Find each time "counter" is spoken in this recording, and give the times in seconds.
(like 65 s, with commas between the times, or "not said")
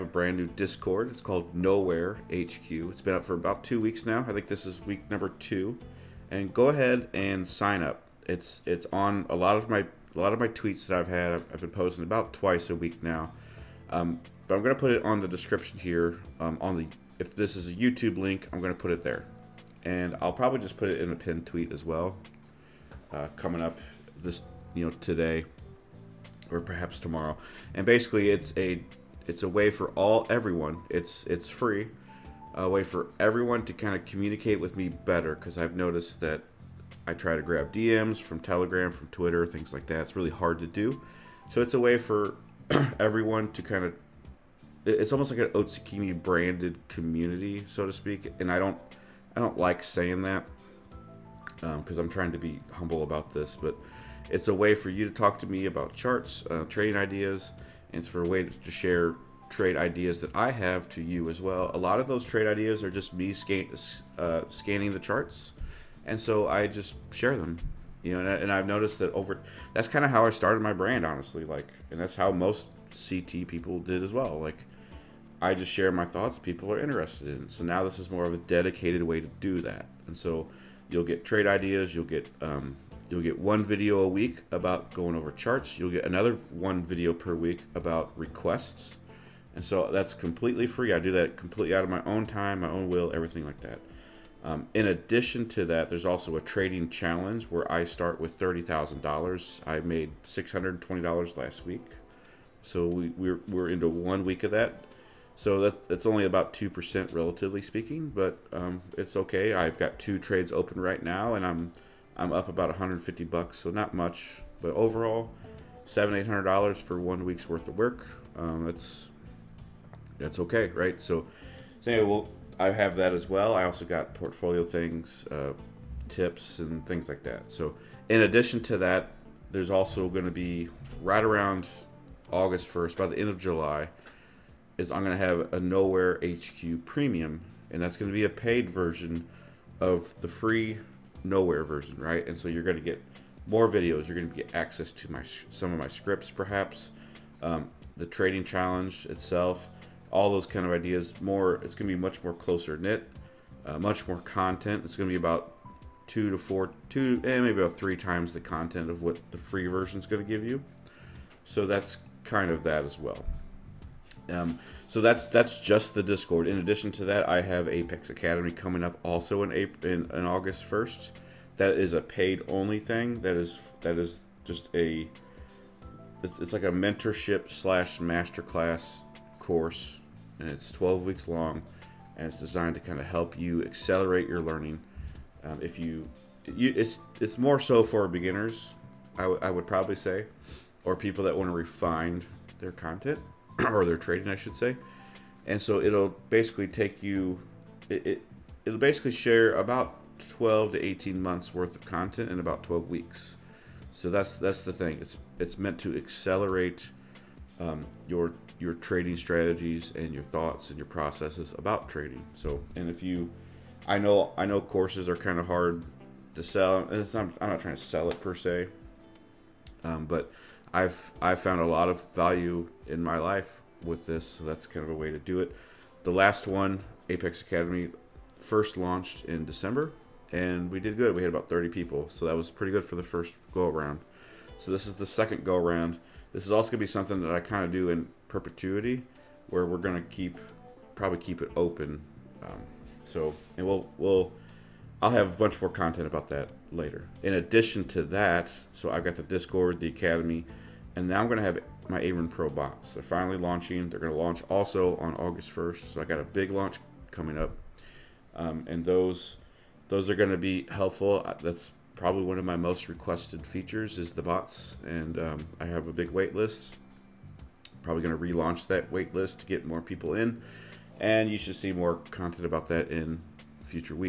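not said.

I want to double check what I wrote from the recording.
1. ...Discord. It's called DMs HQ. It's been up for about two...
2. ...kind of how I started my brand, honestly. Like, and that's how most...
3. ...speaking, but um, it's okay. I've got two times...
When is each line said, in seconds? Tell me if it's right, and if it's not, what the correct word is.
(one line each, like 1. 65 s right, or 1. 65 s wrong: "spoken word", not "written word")
1. 0 s wrong: "Knowhere", not "DMs"
2. 69 s right
3. 107 s wrong: "trades", not "times".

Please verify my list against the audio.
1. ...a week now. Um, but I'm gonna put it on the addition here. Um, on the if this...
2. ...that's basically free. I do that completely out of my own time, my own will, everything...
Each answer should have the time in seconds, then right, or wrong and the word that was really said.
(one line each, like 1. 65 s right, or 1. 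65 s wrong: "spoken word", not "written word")
1. 12 s wrong: "description", not "addition"
2. 89 s wrong: "completely", not "basically".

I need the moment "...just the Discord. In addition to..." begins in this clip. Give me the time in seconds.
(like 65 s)
165 s.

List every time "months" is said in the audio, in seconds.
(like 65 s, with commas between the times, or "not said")
201 s.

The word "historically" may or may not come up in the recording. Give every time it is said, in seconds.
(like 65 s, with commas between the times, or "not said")
not said.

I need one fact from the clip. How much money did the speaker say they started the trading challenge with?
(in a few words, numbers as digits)
$30,000.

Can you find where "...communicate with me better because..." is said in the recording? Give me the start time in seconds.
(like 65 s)
34 s.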